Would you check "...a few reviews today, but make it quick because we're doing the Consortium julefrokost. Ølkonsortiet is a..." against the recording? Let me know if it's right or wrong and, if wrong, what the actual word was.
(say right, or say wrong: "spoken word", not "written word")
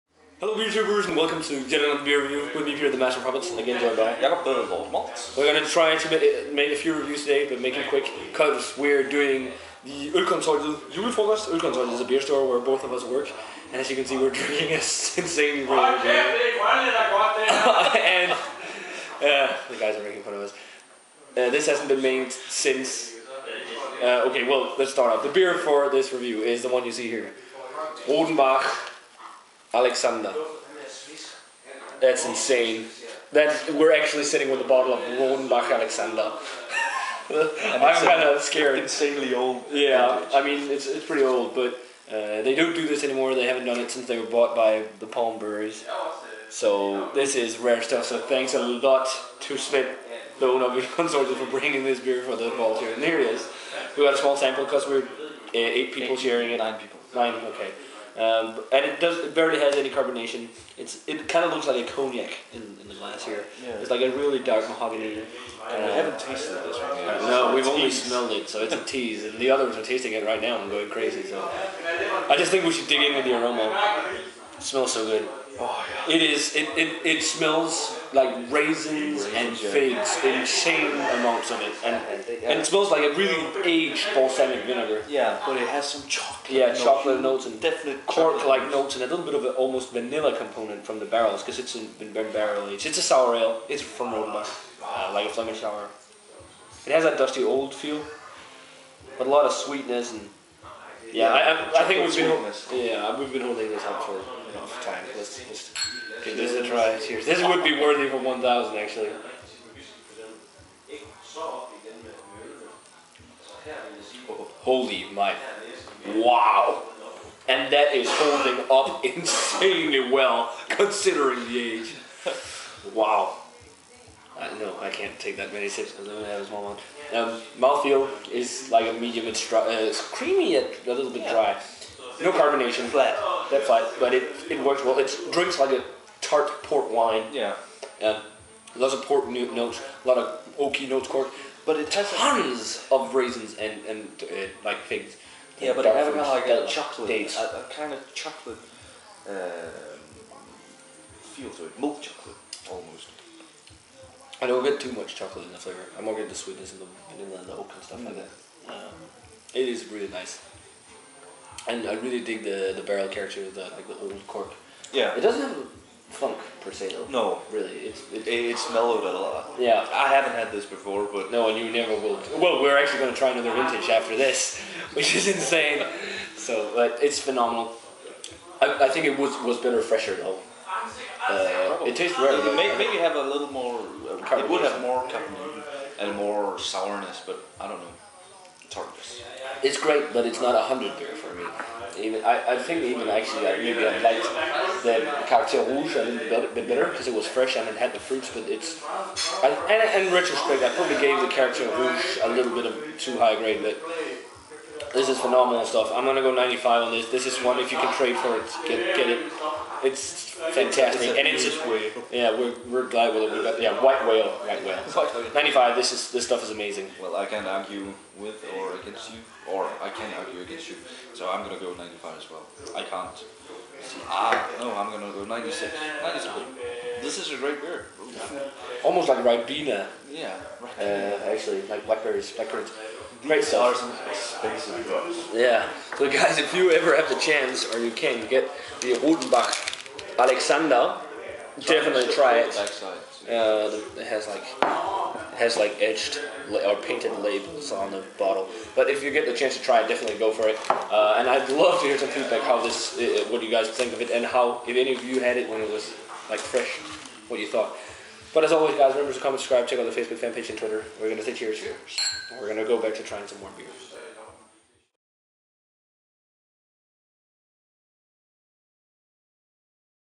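wrong: "Ølkonsortiet", not "Consortium".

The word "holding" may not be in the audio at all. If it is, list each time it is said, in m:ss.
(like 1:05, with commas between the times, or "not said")
1:43, 1:58.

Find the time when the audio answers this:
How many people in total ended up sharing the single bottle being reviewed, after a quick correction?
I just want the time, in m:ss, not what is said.
0:56.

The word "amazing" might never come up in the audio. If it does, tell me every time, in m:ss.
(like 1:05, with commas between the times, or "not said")
3:36.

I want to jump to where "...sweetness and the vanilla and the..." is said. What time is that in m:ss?
2:36.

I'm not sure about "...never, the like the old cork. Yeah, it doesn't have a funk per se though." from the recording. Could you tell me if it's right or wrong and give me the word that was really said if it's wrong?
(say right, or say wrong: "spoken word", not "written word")
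wrong: "character", not "never".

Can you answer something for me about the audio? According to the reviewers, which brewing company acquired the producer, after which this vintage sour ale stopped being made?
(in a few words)
Palm Breweries.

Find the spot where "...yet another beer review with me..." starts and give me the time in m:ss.
0:01.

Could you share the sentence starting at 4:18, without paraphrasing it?
But as always, guys, remember to comment, subscribe, check out the Facebook fan page and Twitter.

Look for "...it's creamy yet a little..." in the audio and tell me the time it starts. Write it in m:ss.
2:09.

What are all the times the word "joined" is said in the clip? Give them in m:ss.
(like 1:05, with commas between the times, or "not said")
0:03.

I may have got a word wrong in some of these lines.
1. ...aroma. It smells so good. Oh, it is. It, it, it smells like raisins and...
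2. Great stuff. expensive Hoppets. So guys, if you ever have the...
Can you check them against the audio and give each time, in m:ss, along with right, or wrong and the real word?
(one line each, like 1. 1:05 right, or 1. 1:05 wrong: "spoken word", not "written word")
1. 1:13 right
2. 3:53 wrong: "Yeah", not "Hoppets".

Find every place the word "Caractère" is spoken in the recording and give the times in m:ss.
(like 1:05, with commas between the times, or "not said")
3:15, 3:21.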